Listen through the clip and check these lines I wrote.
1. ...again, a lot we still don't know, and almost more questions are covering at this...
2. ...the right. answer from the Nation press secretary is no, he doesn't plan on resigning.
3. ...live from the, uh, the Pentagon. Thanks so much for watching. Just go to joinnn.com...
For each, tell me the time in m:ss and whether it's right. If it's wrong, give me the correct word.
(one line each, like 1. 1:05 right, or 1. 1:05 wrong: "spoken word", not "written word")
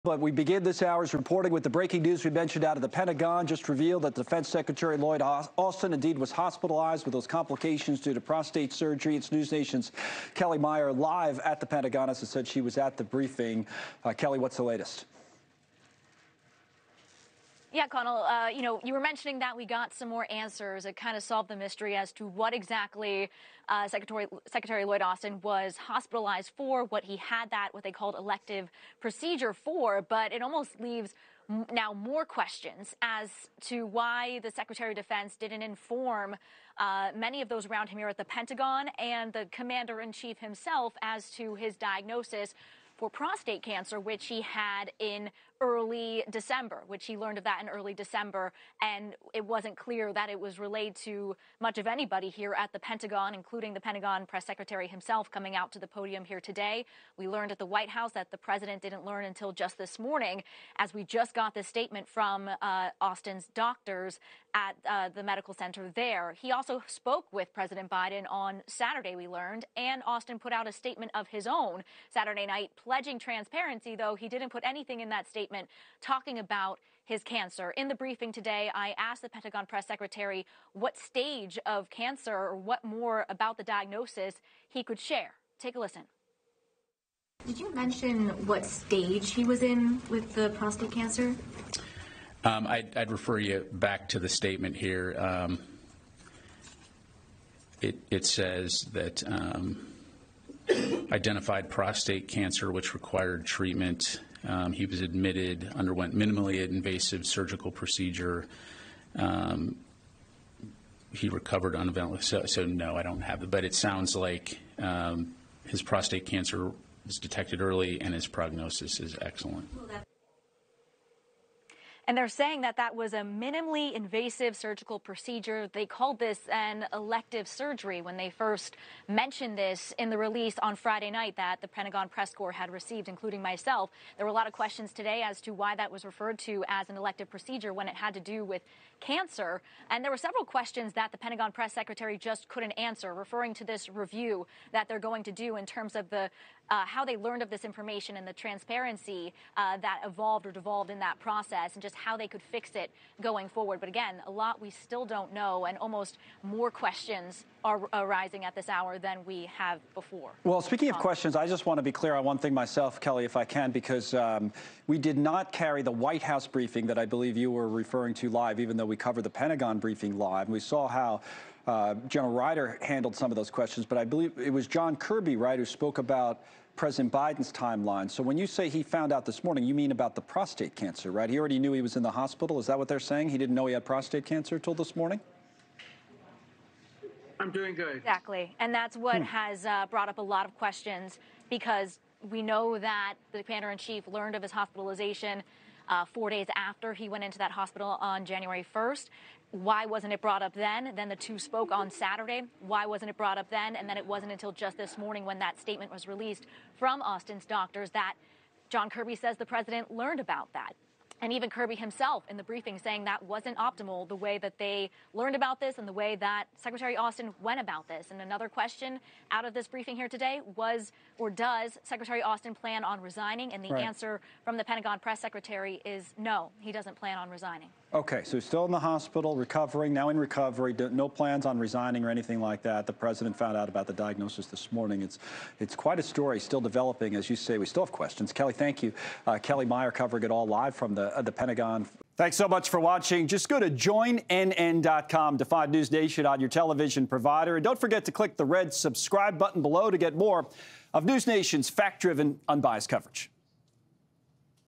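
1. 2:33 wrong: "arising", not "covering"
2. 3:43 wrong: "Pentagon", not "Nation"
3. 4:00 right.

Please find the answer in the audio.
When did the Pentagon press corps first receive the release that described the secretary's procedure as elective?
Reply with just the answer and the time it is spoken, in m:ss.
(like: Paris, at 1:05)
Friday night, at 2:10.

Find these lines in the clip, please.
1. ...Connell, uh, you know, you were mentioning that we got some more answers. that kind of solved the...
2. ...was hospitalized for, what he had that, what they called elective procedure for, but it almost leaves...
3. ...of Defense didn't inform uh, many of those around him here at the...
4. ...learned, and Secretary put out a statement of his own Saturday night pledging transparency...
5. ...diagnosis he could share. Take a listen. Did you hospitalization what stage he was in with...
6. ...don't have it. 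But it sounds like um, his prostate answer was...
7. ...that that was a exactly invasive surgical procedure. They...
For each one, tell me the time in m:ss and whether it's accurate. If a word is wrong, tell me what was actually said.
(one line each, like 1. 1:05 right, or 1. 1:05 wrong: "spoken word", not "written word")
1. 0:17 right
2. 0:25 right
3. 0:34 right
4. 1:09 wrong: "Austin", not "Secretary"
5. 1:23 wrong: "mention", not "hospitalization"
6. 1:53 wrong: "cancer", not "answer"
7. 2:02 wrong: "minimally", not "exactly".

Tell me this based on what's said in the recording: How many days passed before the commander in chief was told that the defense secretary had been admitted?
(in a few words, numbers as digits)
4.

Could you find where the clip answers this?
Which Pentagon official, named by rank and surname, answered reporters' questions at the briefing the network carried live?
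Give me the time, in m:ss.
2:52.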